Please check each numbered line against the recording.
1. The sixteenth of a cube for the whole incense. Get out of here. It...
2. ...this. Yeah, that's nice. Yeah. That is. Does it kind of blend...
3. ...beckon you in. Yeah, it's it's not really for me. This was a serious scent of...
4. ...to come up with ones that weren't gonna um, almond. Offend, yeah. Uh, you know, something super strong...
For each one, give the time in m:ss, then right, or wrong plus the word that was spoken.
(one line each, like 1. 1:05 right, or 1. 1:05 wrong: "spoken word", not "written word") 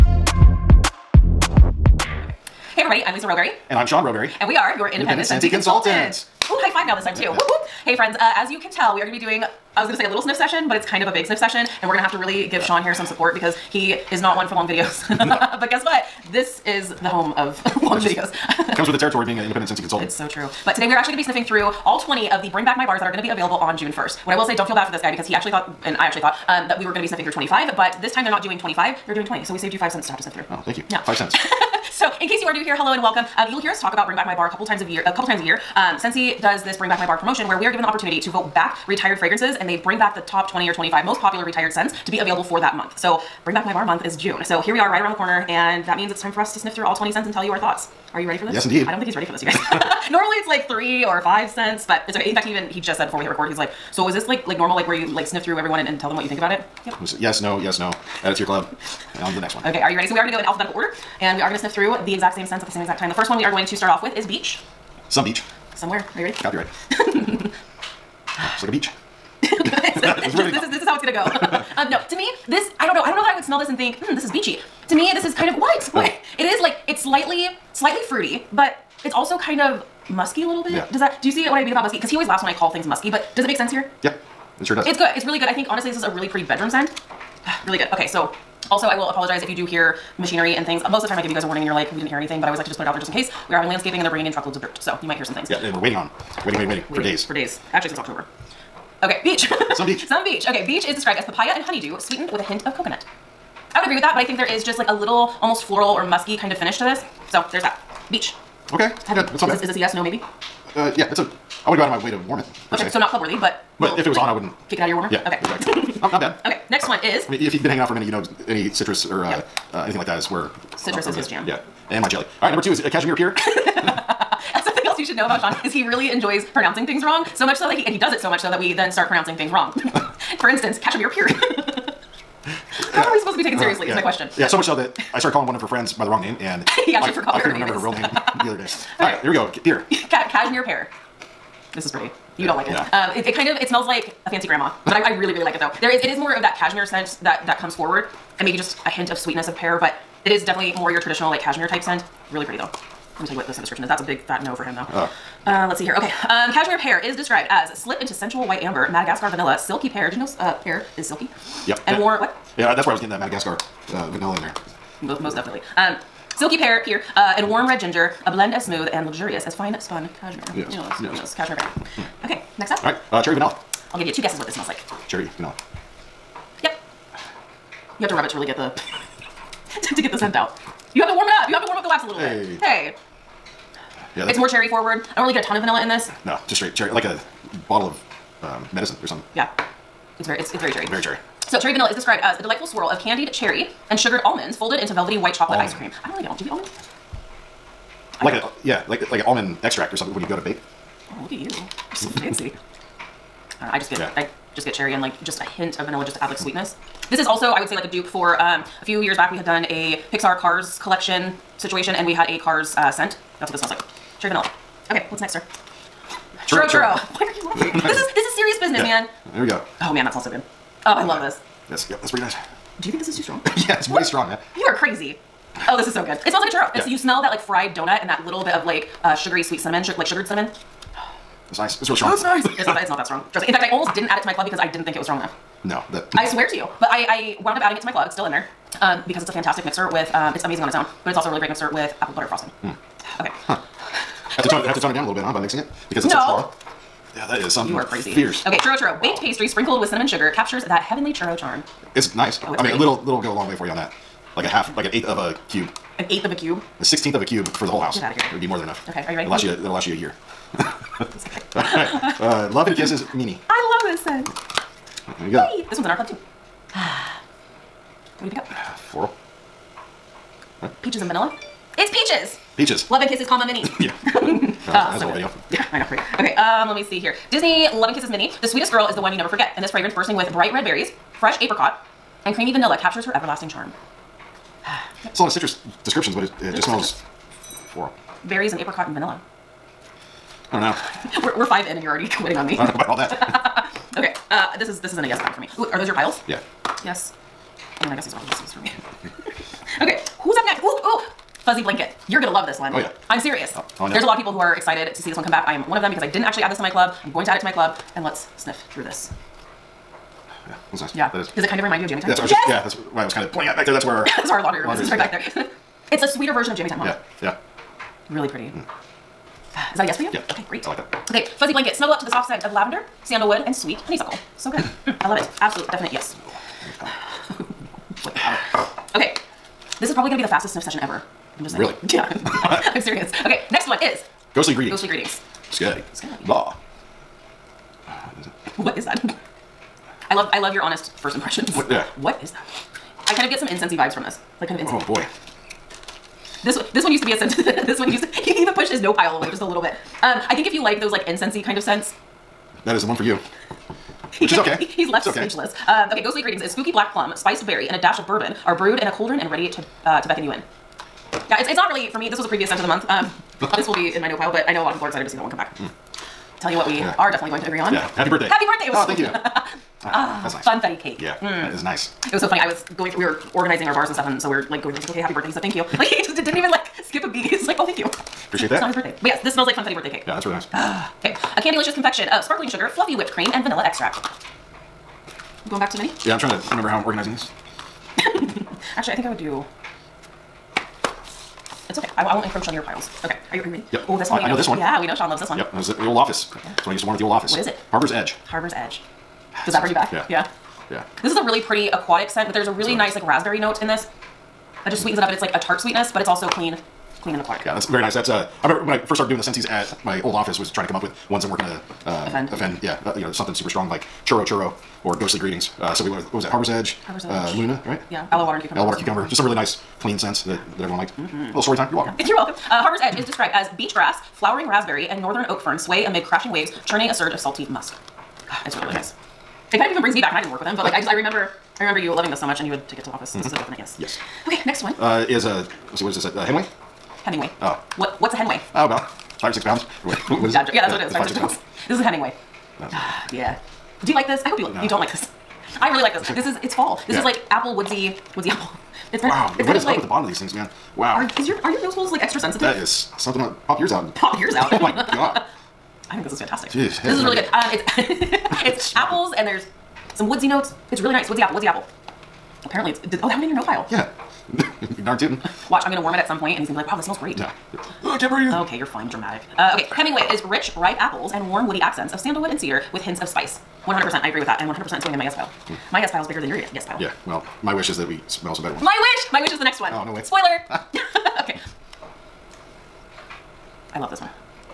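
1. 4:16 wrong: "house", not "incense"
2. 5:08 wrong: "remind", not "blend"
3. 6:00 wrong: "previous", not "serious"
4. 6:50 wrong: "offend", not "almond".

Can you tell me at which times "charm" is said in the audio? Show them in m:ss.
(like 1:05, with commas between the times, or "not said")
4:11, 4:43.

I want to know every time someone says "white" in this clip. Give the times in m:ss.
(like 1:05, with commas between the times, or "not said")
2:38, 3:15.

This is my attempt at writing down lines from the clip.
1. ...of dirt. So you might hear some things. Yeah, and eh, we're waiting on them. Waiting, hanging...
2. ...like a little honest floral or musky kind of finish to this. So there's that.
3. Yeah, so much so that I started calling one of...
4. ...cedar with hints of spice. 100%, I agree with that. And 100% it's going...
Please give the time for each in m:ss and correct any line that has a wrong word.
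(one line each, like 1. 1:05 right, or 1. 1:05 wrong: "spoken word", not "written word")
1. 1:34 wrong: "waiting", not "hanging"
2. 1:44 wrong: "almost", not "honest"
3. 2:14 right
4. 7:52 right.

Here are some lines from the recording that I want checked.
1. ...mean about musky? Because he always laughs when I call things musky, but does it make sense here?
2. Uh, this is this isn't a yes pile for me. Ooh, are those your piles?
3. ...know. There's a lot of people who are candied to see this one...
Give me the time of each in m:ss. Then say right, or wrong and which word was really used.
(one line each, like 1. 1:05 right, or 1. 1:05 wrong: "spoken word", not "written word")
1. 1:21 right
2. 4:54 right
3. 5:03 wrong: "excited", not "candied".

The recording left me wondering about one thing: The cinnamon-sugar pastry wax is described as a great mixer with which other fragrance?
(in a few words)
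Apple butter frosting.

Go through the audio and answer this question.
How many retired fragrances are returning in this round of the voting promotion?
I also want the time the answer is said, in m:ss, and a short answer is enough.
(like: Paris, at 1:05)
20, at 0:29.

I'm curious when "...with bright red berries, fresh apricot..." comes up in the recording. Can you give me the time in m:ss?
4:40.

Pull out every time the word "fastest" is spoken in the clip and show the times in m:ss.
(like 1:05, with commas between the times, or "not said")
5:30.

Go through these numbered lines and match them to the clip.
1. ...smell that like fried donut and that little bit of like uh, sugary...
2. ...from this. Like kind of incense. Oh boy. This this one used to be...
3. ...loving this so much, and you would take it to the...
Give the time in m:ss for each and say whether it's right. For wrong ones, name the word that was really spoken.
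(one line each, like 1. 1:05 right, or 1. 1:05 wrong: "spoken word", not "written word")
1. 3:46 right
2. 5:43 right
3. 7:11 right.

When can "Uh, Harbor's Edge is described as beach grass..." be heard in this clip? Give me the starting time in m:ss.
7:02.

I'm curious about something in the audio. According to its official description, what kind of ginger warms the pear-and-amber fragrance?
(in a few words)
Red ginger.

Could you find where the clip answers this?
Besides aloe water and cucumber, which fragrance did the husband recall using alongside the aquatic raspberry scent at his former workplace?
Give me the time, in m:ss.
6:57.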